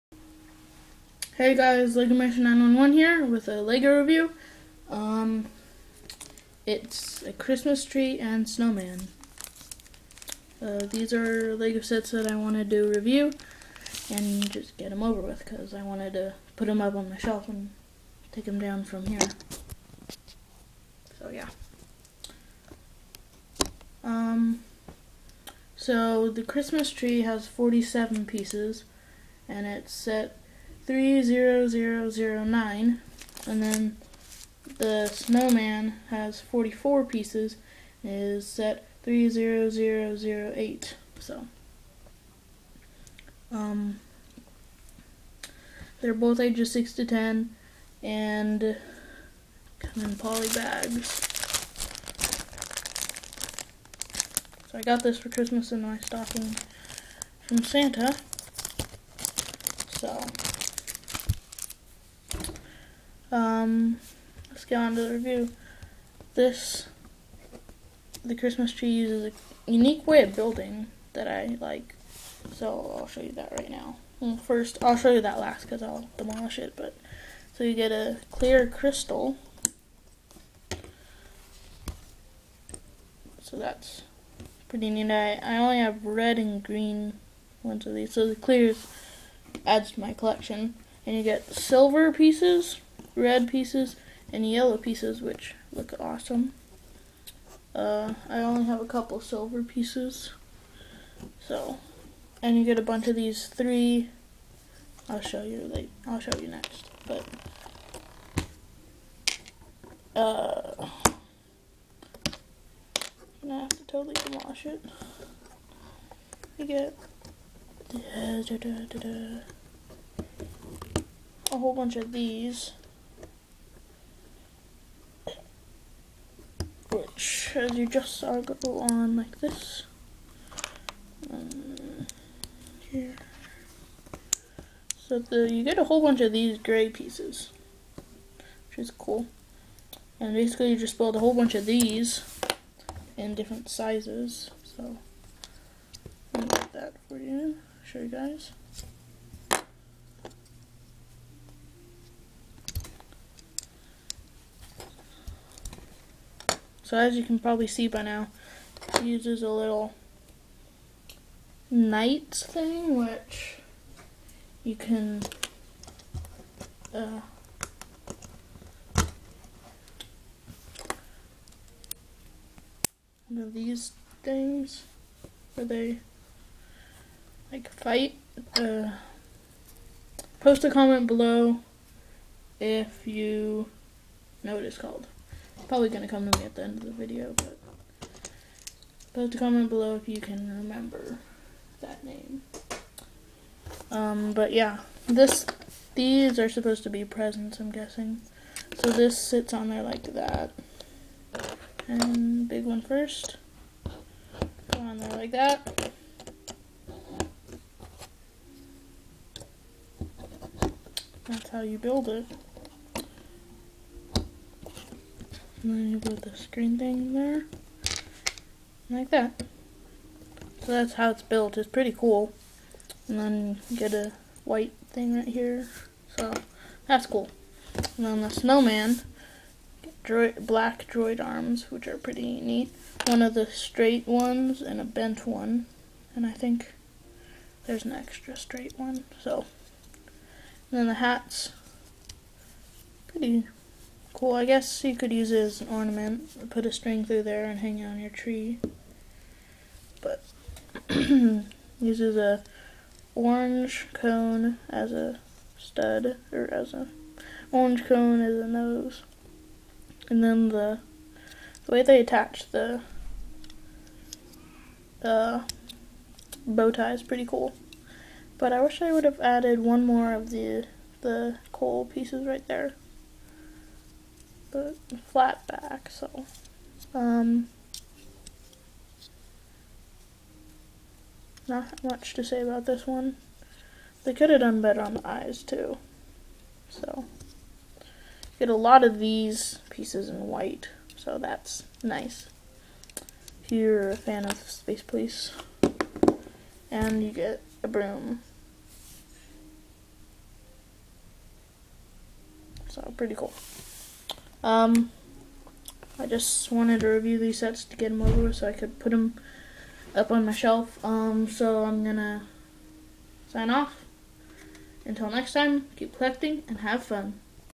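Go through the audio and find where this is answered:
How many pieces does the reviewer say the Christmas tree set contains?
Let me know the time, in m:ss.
0:27.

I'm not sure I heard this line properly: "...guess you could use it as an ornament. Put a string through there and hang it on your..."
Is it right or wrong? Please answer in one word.
right.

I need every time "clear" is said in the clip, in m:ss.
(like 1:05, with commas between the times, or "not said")
1:18, 1:28.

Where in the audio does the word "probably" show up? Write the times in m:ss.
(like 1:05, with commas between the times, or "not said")
2:37, 3:05.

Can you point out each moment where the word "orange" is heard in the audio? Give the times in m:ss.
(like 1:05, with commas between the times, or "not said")
4:13, 4:17.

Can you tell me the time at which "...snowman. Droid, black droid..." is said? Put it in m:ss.
3:48.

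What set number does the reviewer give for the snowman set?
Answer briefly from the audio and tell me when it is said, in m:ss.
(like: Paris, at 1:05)
30008, at 0:39.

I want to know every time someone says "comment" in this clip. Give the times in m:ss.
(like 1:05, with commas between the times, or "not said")
3:00, 3:09.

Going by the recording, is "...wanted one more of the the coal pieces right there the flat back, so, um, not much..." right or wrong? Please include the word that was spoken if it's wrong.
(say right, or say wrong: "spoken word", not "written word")
wrong: "added", not "wanted".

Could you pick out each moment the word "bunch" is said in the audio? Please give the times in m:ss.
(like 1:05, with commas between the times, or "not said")
1:42, 2:01, 2:16, 2:21.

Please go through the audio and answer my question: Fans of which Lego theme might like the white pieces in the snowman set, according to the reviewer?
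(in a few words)
Space Police.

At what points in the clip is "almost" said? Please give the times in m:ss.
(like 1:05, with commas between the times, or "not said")
not said.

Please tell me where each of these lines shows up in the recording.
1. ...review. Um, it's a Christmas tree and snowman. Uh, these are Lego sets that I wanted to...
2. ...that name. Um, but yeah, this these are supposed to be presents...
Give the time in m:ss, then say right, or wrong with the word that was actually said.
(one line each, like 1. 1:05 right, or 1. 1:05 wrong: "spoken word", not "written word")
1. 0:03 right
2. 3:11 right.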